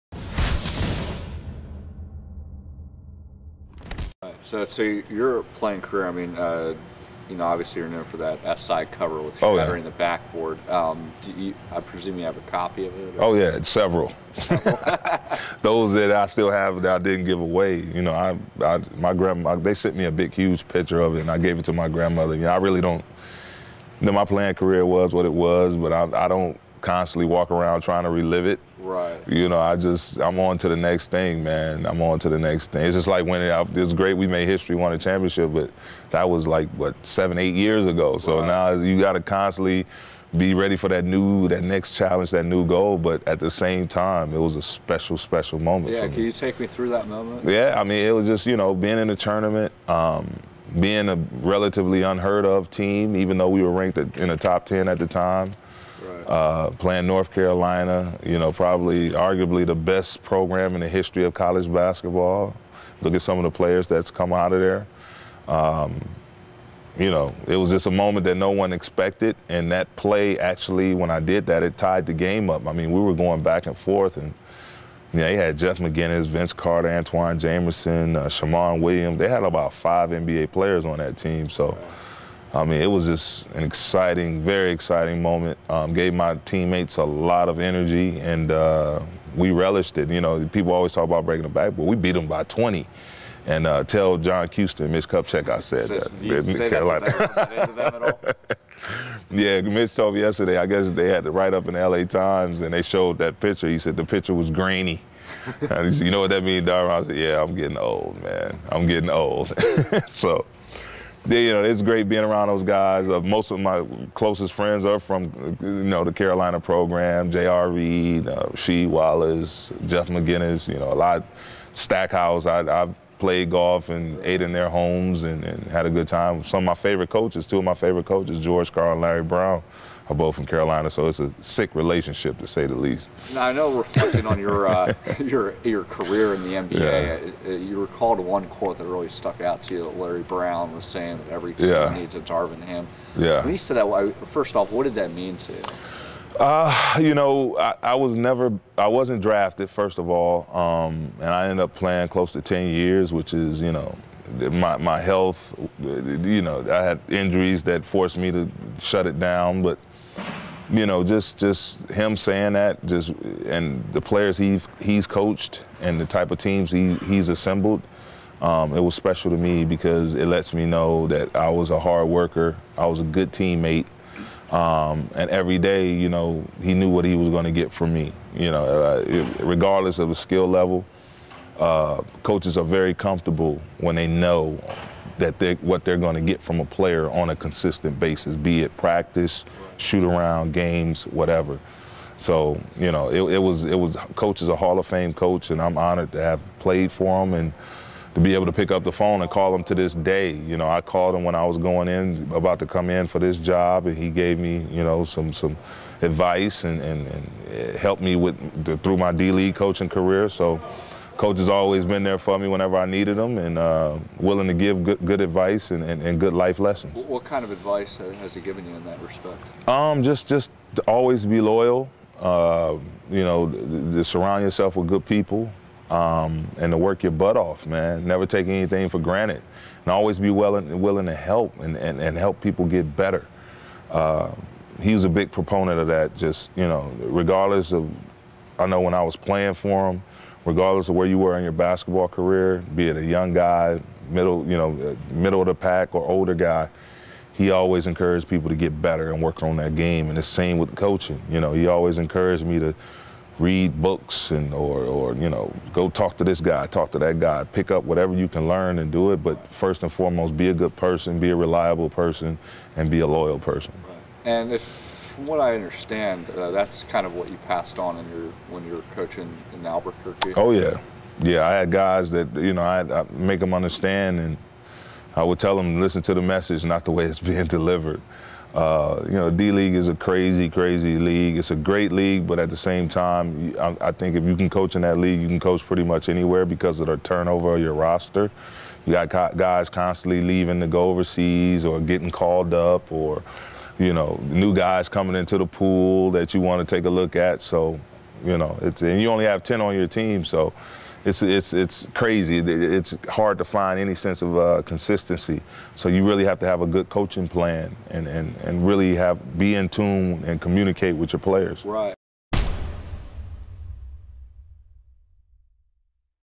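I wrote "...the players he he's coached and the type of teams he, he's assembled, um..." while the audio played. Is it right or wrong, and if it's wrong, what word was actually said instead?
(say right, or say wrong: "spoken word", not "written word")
right.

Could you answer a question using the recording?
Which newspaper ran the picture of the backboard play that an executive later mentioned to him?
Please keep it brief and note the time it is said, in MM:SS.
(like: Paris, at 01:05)
L.A. Times, at 01:41.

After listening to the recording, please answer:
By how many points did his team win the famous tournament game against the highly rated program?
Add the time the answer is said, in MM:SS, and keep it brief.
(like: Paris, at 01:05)
20, at 01:32.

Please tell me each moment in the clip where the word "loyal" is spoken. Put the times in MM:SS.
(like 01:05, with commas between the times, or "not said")
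03:41, 04:23.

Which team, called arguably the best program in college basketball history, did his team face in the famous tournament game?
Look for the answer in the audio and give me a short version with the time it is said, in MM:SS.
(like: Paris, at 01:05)
North Carolina, at 00:57.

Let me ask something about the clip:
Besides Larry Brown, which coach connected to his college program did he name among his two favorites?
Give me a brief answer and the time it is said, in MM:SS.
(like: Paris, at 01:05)
George Karl, at 02:08.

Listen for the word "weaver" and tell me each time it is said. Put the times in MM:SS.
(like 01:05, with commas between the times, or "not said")
not said.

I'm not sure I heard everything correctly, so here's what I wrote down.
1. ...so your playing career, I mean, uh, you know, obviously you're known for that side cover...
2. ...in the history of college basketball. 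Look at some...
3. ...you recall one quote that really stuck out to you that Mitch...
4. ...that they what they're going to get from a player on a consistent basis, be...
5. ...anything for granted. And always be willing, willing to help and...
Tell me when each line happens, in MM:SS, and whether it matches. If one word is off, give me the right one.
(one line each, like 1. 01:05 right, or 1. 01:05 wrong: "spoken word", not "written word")
1. 00:04 right
2. 01:00 right
3. 02:17 wrong: "Larry", not "Mitch"
4. 03:05 right
5. 03:48 right.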